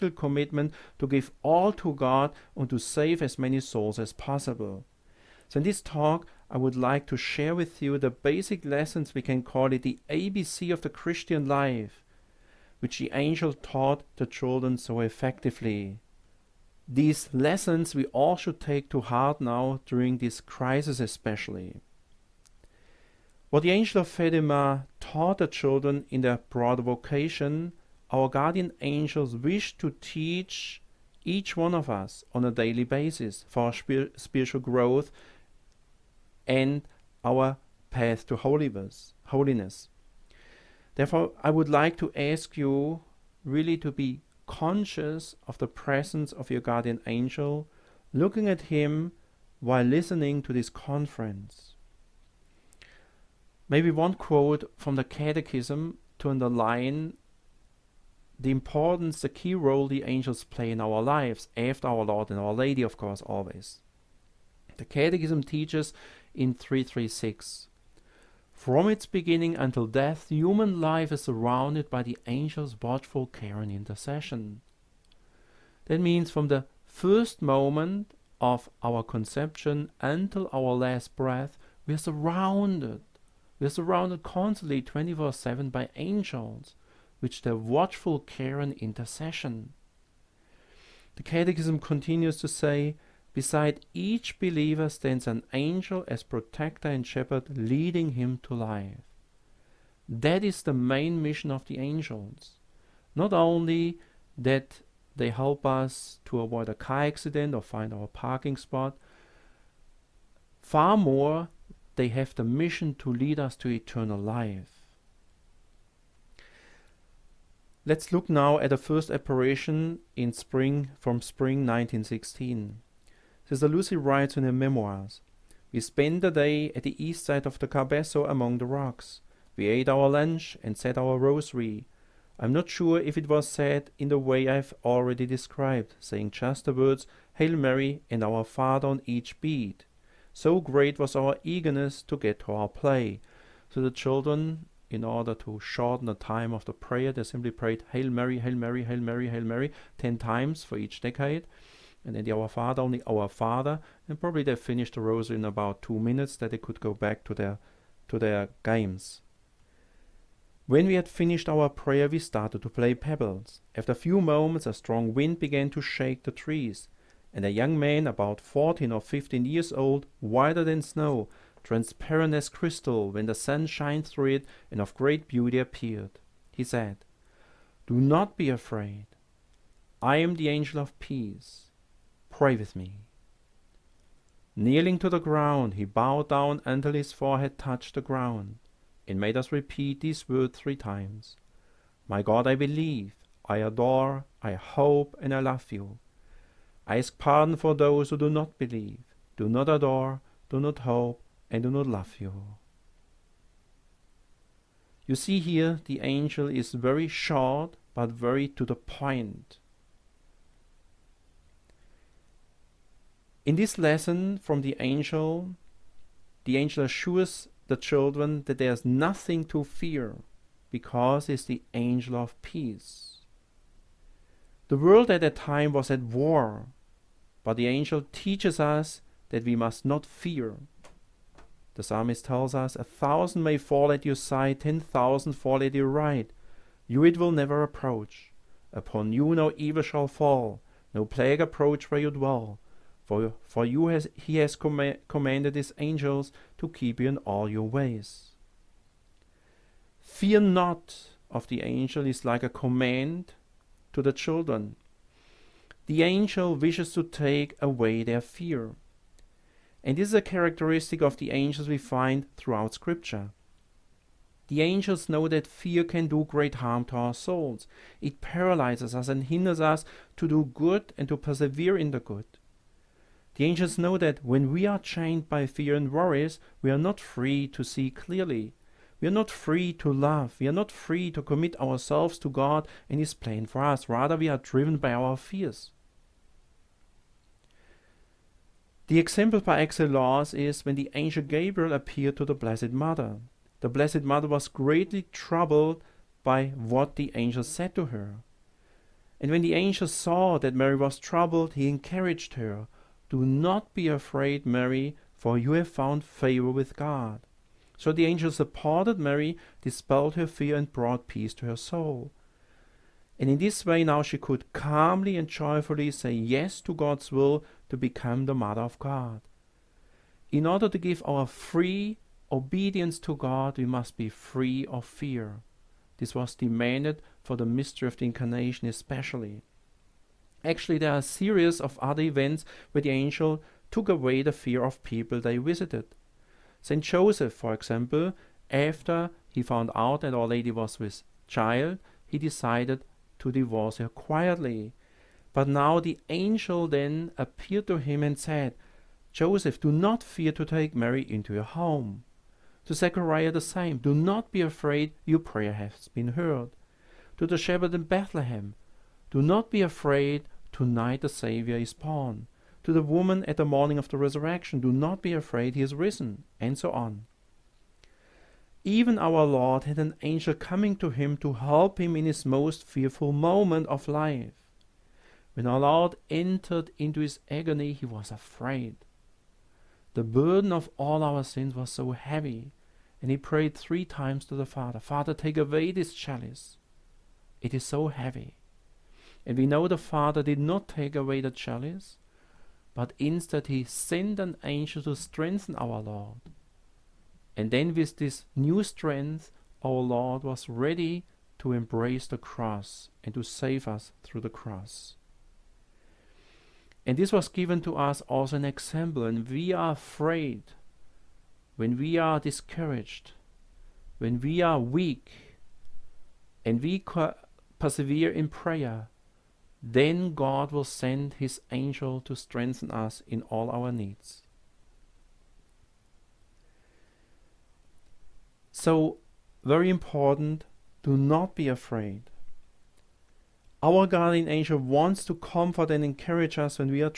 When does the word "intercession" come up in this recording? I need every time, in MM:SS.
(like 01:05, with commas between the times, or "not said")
01:13, 01:28.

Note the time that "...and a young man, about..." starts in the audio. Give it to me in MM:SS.
02:47.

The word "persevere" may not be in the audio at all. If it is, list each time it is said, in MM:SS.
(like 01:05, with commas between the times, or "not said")
04:31, 06:57.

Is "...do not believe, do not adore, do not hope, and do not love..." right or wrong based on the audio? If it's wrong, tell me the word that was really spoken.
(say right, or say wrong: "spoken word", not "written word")
right.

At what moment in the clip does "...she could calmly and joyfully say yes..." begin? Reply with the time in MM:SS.
05:14.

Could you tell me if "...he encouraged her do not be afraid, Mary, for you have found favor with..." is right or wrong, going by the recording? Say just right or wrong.
right.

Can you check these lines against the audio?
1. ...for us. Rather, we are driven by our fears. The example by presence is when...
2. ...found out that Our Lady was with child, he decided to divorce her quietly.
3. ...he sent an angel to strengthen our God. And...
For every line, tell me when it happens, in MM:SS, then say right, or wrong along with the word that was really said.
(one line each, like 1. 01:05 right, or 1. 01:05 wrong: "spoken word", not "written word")
1. 04:43 wrong: "excellence", not "presence"
2. 05:39 right
3. 06:33 wrong: "Lord", not "God".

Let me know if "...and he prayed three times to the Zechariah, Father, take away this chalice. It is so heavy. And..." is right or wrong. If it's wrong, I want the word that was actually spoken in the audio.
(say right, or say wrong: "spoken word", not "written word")
wrong: "Father", not "Zechariah".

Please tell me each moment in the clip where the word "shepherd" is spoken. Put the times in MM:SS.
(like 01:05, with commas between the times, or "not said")
01:37, 05:57.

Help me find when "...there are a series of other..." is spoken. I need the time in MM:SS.
05:30.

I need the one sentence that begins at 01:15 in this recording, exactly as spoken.
That means from the first moment of our conception until our last breath, we are surrounded.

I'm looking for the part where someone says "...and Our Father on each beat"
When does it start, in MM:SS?
02:18.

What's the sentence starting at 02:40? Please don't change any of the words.
When we had finished our prayer, we started to play pebbles.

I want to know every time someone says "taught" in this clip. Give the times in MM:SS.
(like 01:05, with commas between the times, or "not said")
00:13, 00:24.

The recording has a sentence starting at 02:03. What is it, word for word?
Sister Lucy writes in her memoirs, We spent the day at the east side of the Cabeço among the rocks.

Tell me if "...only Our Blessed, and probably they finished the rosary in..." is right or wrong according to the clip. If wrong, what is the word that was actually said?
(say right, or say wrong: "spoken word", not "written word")
wrong: "Father", not "Blessed".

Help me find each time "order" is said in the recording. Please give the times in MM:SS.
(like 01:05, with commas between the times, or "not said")
02:25, 05:20.